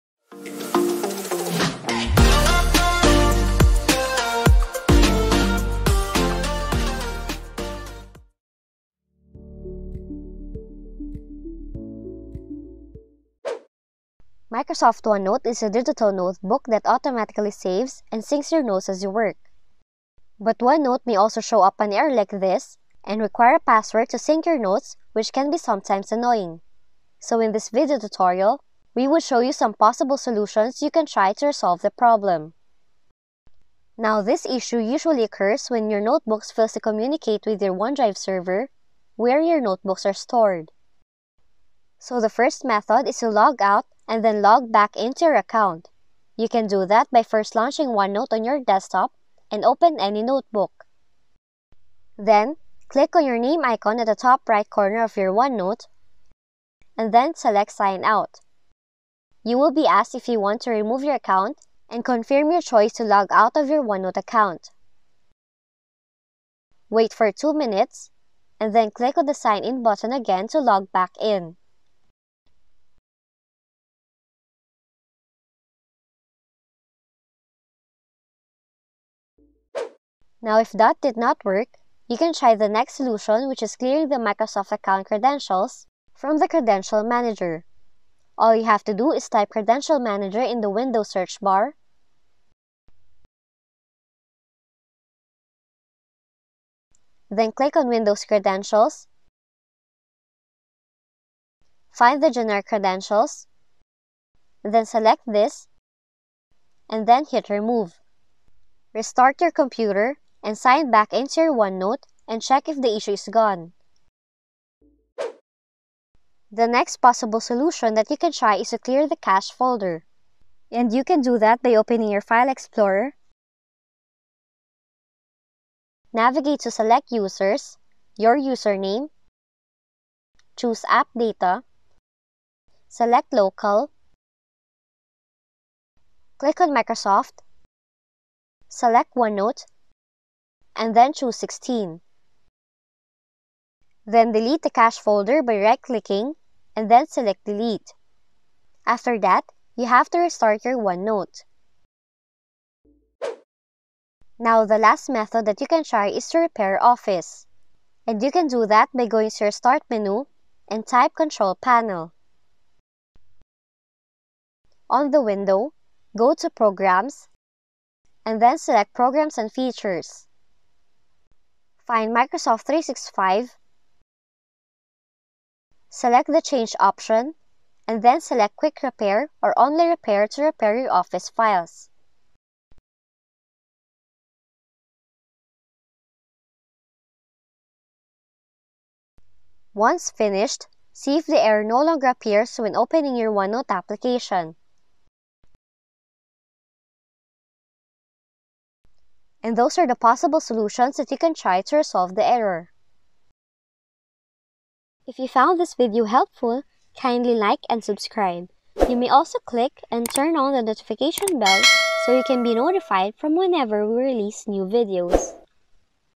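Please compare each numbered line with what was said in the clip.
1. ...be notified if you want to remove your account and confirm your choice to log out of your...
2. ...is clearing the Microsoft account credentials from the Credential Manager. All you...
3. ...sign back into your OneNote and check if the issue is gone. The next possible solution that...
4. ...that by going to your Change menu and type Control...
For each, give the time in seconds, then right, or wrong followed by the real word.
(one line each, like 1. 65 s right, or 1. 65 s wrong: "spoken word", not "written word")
1. 59 s wrong: "asked", not "notified"
2. 83 s right
3. 110 s right
4. 158 s wrong: "Start", not "Change".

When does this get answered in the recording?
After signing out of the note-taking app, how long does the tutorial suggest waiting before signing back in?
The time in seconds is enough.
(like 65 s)
67 s.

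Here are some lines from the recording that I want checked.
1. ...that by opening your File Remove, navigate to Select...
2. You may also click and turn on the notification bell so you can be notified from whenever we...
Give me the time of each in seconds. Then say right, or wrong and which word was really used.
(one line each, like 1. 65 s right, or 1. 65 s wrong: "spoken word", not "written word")
1. 121 s wrong: "Explorer", not "Remove"
2. 208 s right.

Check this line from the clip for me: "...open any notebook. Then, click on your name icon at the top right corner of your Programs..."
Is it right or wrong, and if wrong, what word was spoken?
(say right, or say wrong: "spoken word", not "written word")
wrong: "OneNote", not "Programs".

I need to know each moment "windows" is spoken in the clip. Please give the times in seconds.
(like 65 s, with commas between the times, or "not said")
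90 s, 97 s, 165 s.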